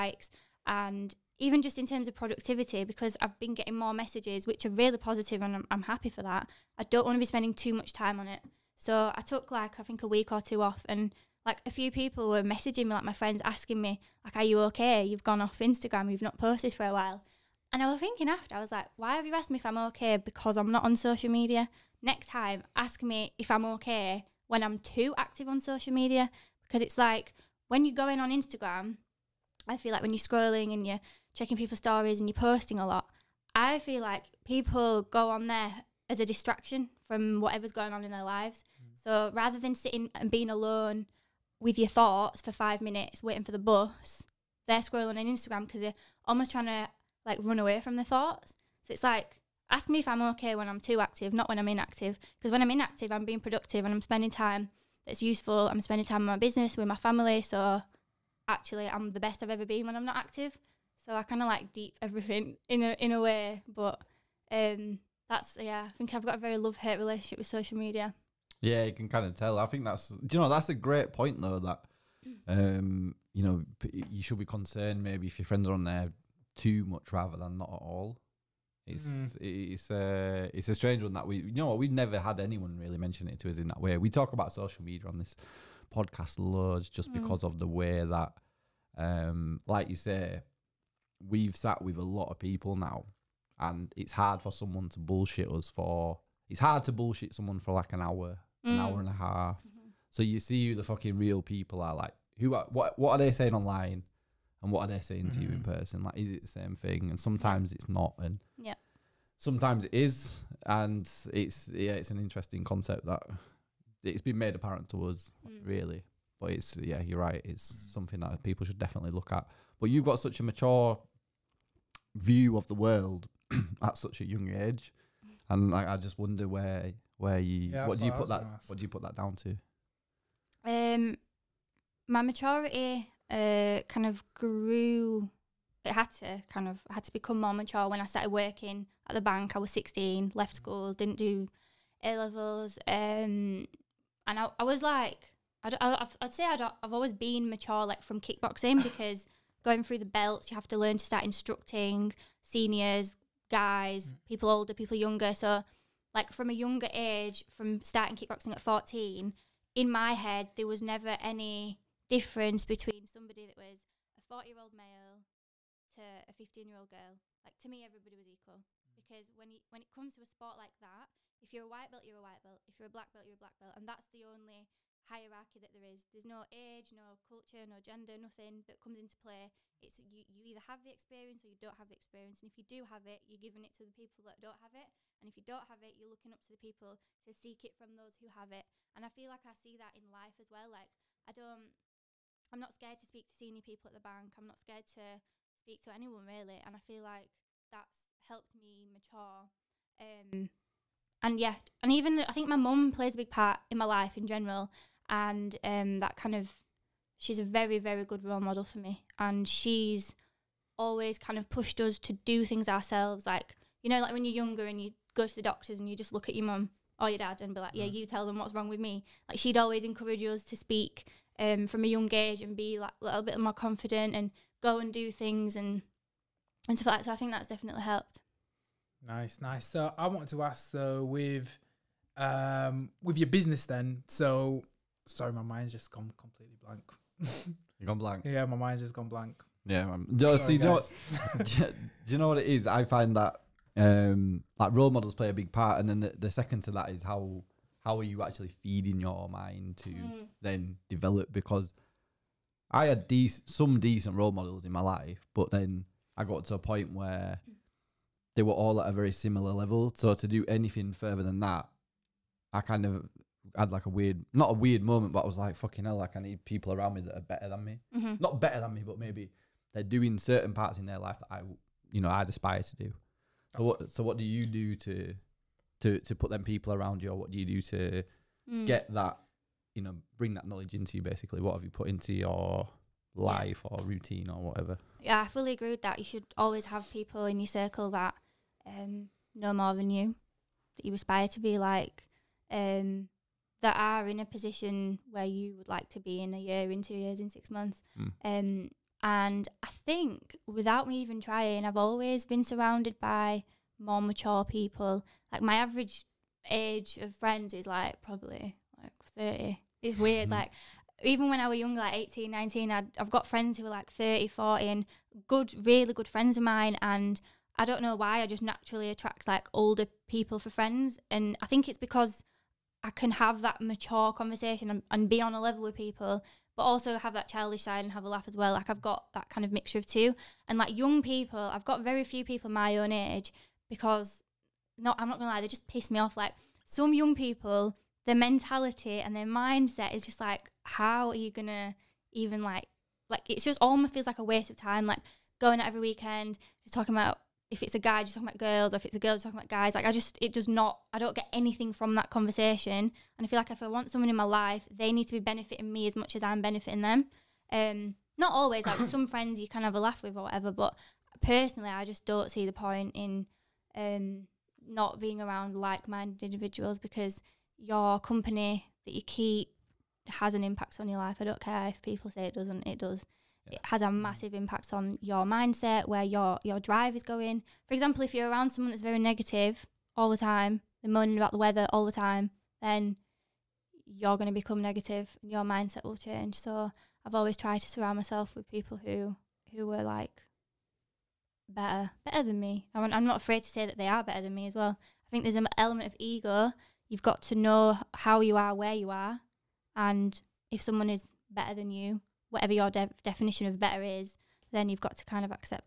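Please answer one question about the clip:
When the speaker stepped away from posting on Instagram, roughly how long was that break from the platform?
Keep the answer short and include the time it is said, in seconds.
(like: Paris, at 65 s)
a week or two, at 10 s.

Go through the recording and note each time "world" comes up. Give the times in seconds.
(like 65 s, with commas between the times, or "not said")
122 s.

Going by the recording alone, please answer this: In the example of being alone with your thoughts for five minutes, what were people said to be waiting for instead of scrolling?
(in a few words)
the bus.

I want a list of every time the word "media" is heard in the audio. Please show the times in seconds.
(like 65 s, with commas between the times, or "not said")
21 s, 25 s, 67 s, 84 s.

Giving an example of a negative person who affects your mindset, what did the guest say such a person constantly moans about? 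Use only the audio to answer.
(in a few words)
the weather.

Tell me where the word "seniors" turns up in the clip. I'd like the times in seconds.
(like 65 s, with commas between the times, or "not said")
152 s, 193 s.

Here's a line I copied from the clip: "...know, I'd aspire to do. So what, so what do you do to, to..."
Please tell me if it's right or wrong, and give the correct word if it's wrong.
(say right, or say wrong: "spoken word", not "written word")
right.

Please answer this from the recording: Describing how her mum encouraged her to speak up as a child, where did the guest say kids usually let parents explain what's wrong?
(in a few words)
the doctors.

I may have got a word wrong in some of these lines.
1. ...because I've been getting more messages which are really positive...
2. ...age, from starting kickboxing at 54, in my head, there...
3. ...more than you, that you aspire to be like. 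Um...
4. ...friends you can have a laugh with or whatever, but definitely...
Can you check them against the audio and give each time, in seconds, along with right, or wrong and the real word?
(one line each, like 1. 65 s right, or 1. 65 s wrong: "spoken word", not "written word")
1. 2 s right
2. 156 s wrong: "14", not "54"
3. 289 s right
4. 359 s wrong: "personally", not "definitely".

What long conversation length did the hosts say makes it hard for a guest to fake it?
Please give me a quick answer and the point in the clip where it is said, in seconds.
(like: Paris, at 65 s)
an hour and a half, at 98 s.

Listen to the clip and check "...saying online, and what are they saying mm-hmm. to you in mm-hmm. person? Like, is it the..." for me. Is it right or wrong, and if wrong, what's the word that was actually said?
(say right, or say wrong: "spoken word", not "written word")
right.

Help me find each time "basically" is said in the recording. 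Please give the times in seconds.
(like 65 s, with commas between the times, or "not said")
281 s.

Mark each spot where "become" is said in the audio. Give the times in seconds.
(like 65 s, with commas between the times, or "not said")
137 s, 384 s.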